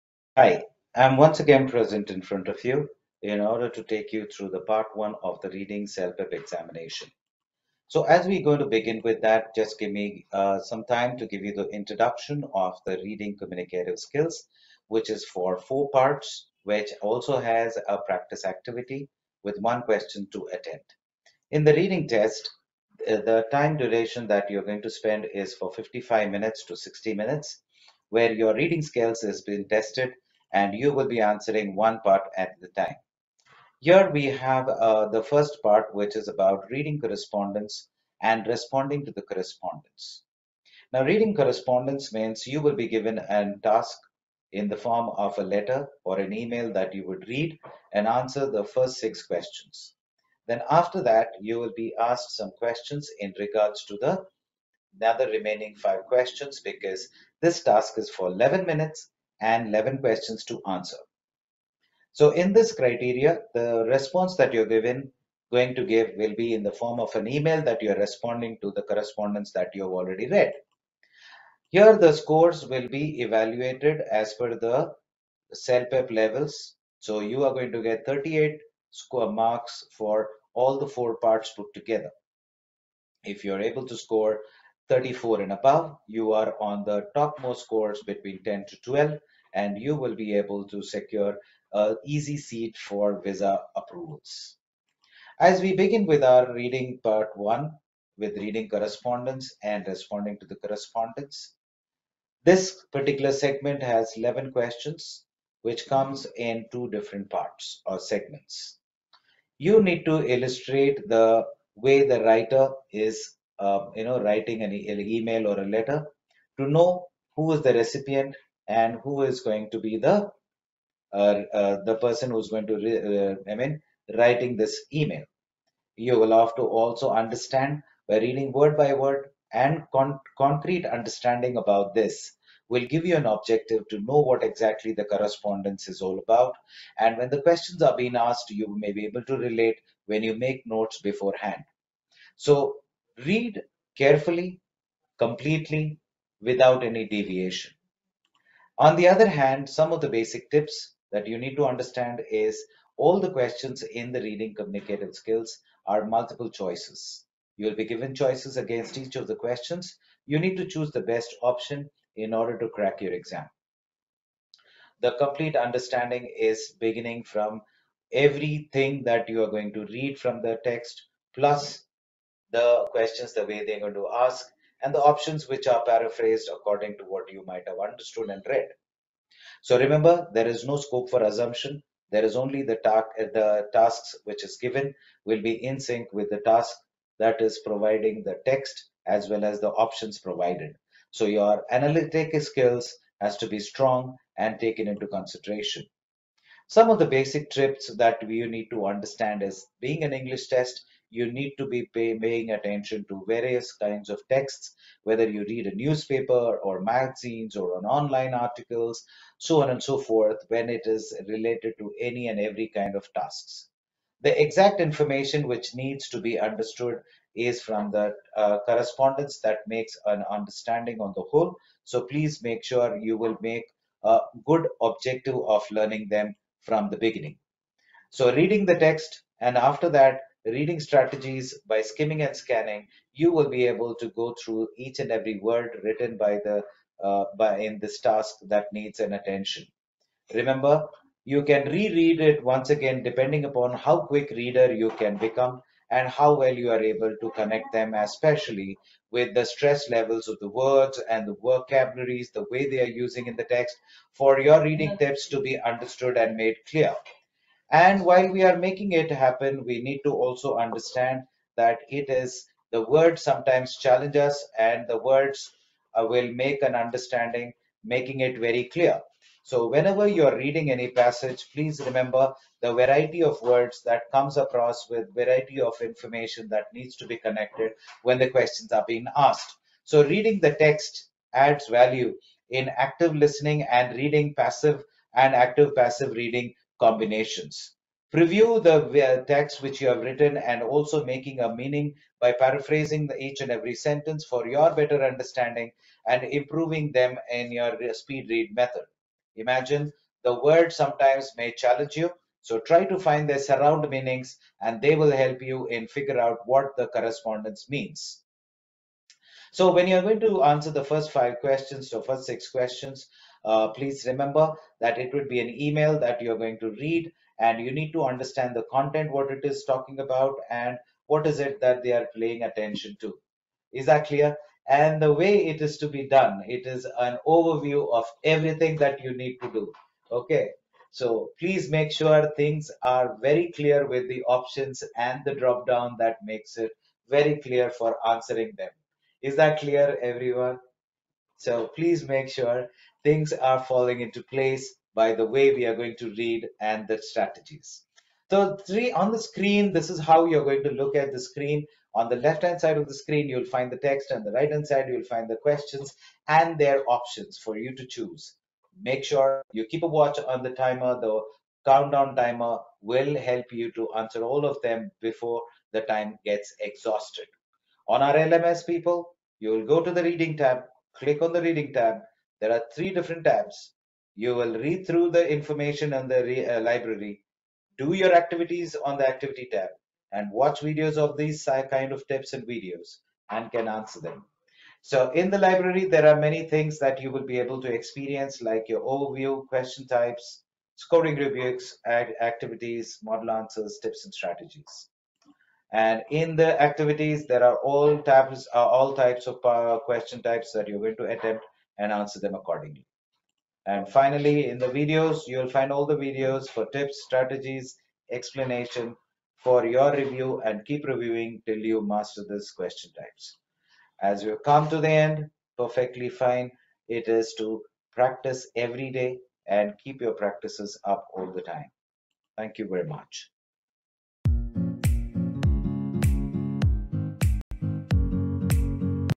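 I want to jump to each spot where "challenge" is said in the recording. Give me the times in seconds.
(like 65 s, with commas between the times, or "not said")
263 s, 301 s.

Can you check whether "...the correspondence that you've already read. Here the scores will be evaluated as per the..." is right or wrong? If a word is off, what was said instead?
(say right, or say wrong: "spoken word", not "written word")
right.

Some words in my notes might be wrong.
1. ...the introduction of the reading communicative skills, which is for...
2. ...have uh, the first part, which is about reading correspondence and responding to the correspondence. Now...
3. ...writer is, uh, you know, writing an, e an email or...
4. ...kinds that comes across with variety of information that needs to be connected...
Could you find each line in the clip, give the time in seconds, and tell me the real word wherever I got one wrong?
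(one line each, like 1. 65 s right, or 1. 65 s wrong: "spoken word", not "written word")
1. 11 s right
2. 34 s right
3. 112 s right
4. 273 s wrong: "words", not "kinds".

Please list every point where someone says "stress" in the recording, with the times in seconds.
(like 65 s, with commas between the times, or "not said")
249 s.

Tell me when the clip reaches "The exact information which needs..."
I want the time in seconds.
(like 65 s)
214 s.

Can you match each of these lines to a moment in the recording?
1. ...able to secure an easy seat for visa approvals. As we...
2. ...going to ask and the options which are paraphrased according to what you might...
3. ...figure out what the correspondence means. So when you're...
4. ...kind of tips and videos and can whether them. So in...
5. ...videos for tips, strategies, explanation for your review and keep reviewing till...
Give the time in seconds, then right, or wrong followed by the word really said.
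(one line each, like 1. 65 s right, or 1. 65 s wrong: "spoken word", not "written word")
1. 90 s right
2. 173 s right
3. 305 s right
4. 381 s wrong: "answer", not "whether"
5. 406 s right.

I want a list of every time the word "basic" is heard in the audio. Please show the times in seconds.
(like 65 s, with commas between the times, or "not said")
150 s, 197 s.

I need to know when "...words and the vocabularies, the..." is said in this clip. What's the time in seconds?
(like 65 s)
250 s.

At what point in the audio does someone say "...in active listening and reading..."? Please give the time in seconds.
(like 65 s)
282 s.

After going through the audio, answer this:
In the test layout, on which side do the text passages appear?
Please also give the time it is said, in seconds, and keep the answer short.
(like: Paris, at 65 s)
left-hand side, at 352 s.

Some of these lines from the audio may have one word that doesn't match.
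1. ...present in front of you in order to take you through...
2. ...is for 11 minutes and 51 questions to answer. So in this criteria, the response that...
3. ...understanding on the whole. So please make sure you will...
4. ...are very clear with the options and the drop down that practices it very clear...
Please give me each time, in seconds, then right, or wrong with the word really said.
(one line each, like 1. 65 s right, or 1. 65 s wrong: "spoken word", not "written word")
1. 1 s right
2. 57 s wrong: "11", not "51"
3. 220 s right
4. 332 s wrong: "makes", not "practices".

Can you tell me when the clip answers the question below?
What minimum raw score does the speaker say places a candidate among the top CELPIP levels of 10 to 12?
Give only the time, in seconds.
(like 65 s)
84 s.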